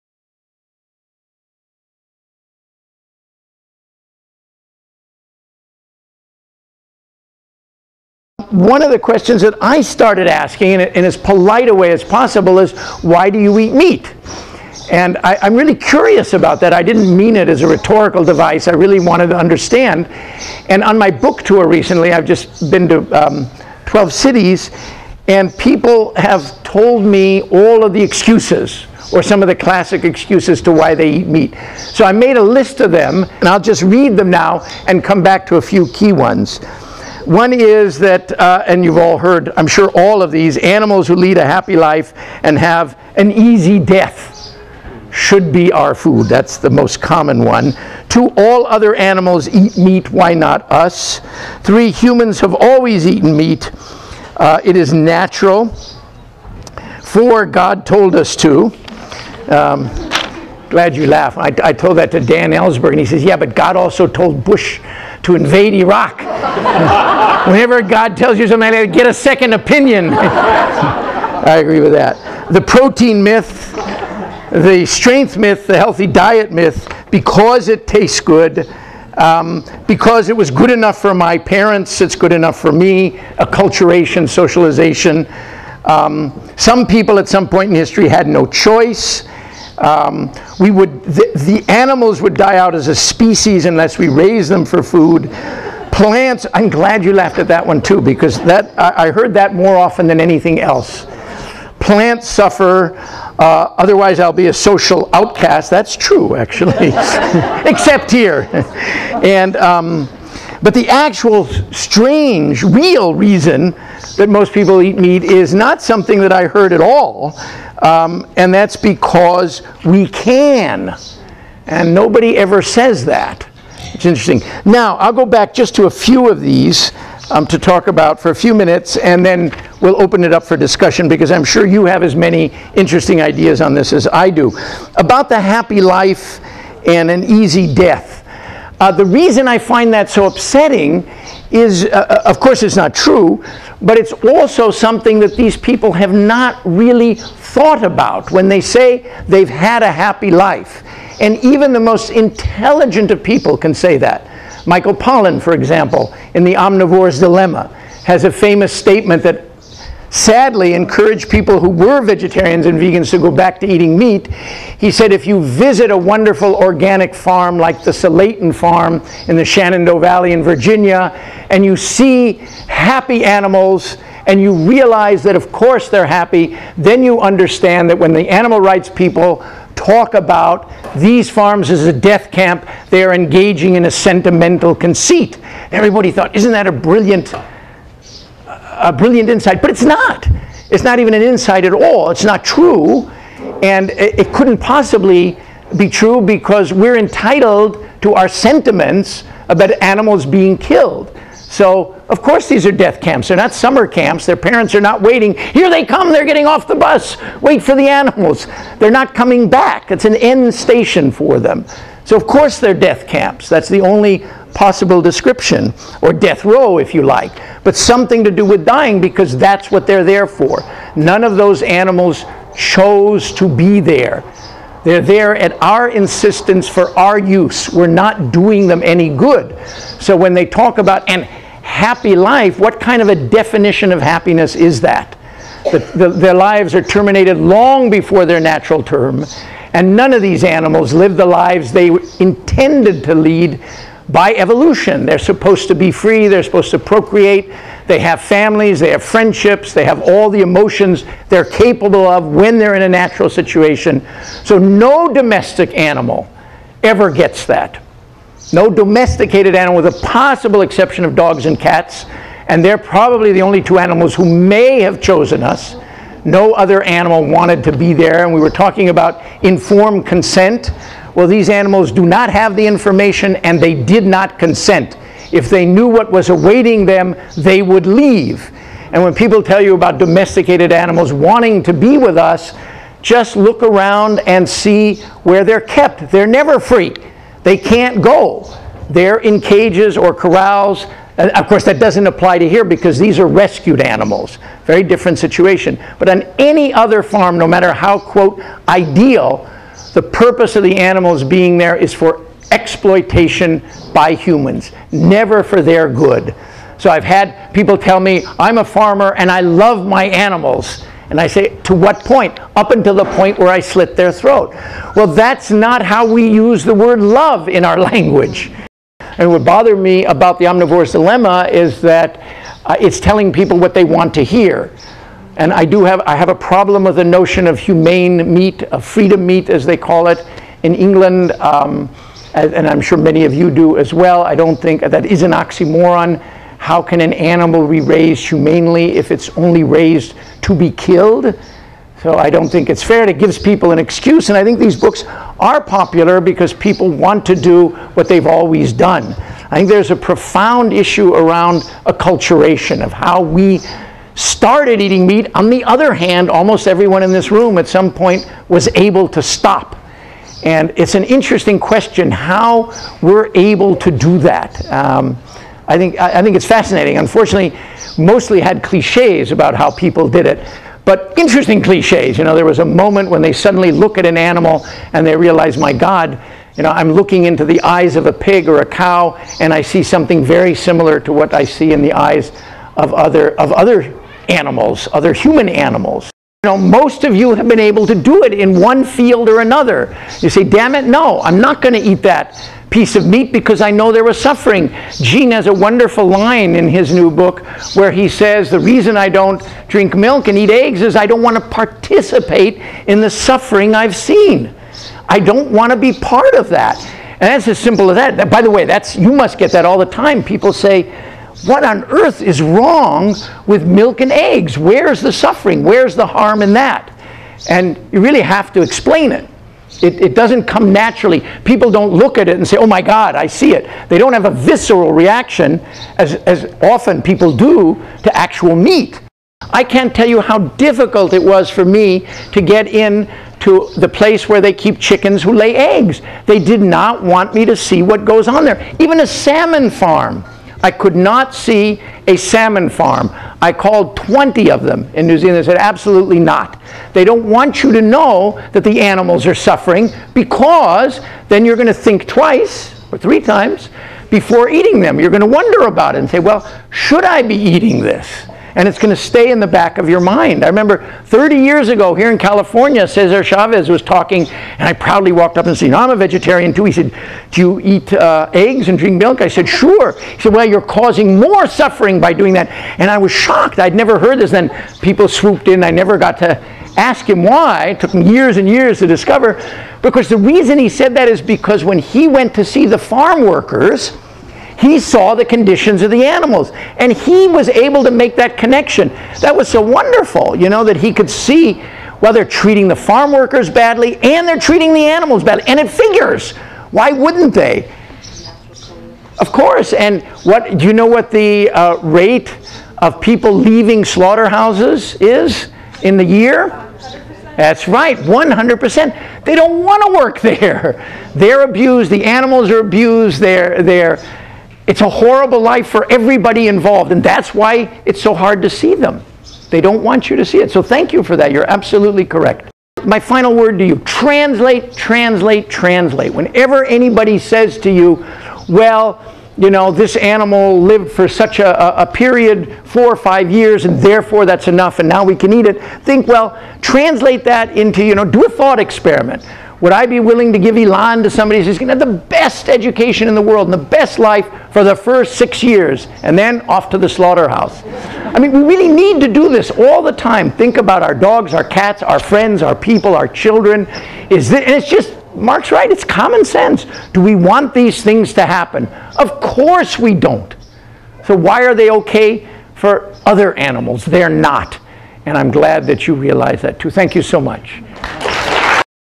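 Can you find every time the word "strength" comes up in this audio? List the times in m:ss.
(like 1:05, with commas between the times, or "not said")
1:14.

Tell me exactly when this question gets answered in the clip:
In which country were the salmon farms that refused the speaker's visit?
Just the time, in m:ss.
7:25.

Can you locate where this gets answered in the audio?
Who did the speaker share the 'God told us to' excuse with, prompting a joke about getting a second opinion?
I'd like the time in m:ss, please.
1:02.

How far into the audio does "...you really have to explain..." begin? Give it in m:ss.
6:57.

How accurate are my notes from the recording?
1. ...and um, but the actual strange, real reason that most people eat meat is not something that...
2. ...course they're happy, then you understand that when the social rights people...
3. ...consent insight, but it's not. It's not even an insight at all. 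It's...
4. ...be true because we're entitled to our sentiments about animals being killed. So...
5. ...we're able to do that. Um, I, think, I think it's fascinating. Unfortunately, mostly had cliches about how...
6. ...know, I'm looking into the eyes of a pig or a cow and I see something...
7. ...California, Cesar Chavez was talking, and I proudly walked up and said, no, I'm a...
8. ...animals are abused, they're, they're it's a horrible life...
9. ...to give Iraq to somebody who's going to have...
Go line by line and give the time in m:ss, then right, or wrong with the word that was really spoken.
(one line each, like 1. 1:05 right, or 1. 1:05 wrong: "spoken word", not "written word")
1. 1:49 right
2. 2:55 wrong: "animal", not "social"
3. 3:08 wrong: "brilliant", not "consent"
4. 3:15 right
5. 6:03 right
6. 6:16 right
7. 7:42 right
8. 8:32 right
9. 9:00 wrong: "Ilan", not "Iraq".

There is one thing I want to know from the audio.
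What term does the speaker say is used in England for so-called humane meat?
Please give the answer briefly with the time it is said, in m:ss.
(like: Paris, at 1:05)
freedom meat, at 5:28.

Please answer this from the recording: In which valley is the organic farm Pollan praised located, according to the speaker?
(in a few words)
Shenandoah Valley.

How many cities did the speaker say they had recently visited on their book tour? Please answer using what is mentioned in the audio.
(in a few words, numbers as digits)
12.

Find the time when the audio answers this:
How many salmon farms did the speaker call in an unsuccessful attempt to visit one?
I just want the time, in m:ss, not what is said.
7:23.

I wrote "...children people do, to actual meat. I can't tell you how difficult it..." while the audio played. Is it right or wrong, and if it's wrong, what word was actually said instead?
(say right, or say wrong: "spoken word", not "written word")
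wrong: "often", not "children".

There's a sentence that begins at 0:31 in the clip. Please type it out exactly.
So I made a list of them, and I'll just read them now and come back to a few key ones.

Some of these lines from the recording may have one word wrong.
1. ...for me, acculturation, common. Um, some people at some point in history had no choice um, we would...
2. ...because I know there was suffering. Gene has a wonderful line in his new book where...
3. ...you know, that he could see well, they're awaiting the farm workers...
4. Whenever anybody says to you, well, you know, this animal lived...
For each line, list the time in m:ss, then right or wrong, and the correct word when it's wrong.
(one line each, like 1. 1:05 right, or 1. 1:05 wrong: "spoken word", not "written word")
1. 1:22 wrong: "socialization", not "common"
2. 6:33 right
3. 8:10 wrong: "treating", not "awaiting"
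4. 8:46 right.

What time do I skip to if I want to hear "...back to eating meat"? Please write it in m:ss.
2:43.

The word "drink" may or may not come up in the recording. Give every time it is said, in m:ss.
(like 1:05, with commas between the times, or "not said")
6:39, 7:48.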